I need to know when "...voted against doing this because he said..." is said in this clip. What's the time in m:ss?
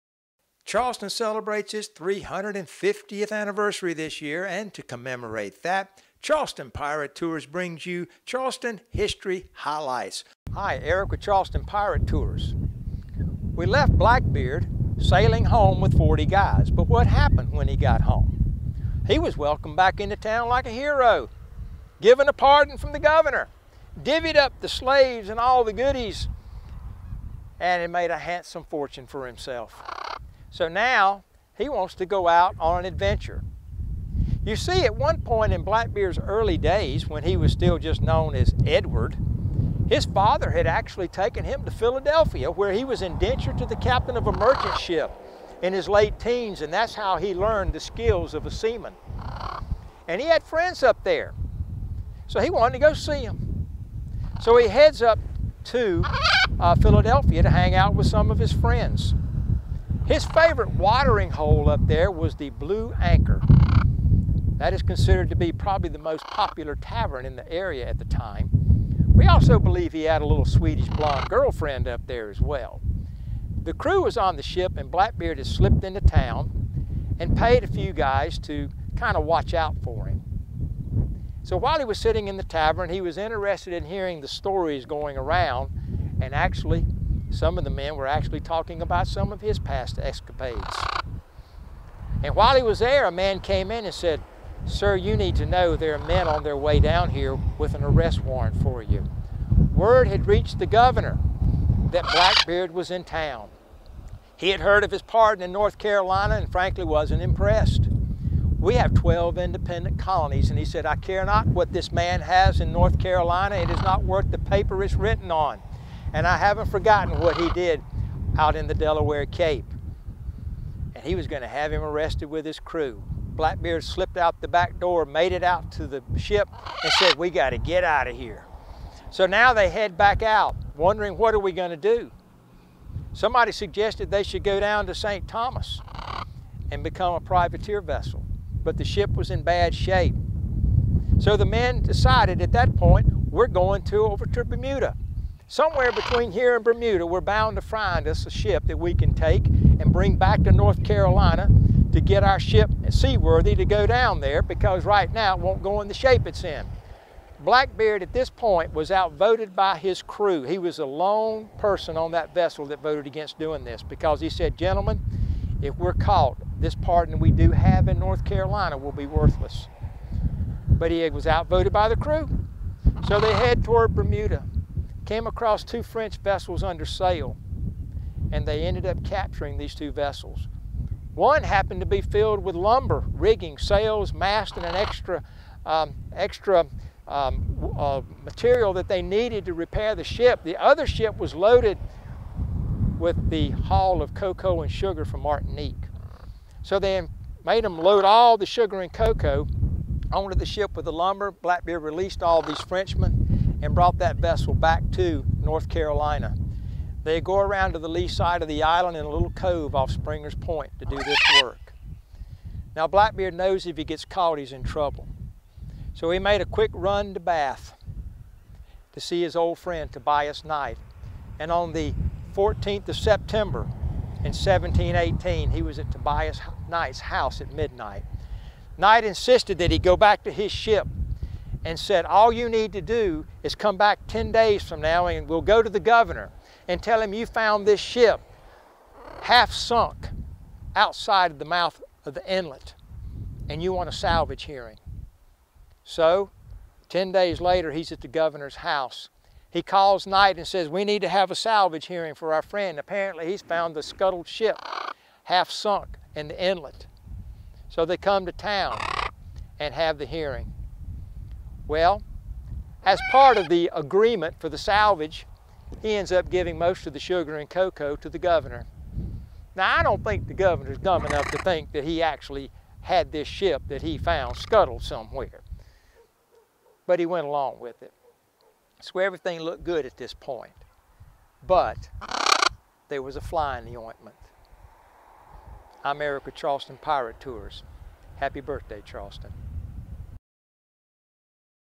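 2:42.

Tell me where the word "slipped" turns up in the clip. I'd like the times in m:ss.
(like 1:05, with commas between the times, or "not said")
1:15, 2:03.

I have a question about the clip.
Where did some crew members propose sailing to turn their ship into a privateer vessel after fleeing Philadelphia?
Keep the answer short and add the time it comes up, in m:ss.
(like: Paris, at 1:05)
St. Thomas, at 2:14.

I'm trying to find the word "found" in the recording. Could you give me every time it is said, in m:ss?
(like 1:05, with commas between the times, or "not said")
3:57, 4:13, 4:33.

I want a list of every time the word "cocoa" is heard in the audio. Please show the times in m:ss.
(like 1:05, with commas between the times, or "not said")
3:14, 3:18, 4:27.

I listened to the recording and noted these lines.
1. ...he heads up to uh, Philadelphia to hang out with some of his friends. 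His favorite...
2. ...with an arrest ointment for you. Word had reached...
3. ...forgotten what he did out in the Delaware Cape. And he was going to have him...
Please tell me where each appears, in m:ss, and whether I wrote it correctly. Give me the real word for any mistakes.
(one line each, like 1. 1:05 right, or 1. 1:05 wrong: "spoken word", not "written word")
1. 0:54 right
2. 1:37 wrong: "warrant", not "ointment"
3. 1:56 right.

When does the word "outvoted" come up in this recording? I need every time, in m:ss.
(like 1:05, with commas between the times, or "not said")
2:38, 2:51.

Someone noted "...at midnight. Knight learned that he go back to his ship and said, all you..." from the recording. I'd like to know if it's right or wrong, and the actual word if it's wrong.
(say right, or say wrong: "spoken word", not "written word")
wrong: "insisted", not "learned".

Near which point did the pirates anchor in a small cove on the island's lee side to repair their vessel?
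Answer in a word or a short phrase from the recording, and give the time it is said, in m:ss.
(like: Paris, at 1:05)
Springer's Point, at 3:29.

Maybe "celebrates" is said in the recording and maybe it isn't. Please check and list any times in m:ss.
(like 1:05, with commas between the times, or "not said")
0:01.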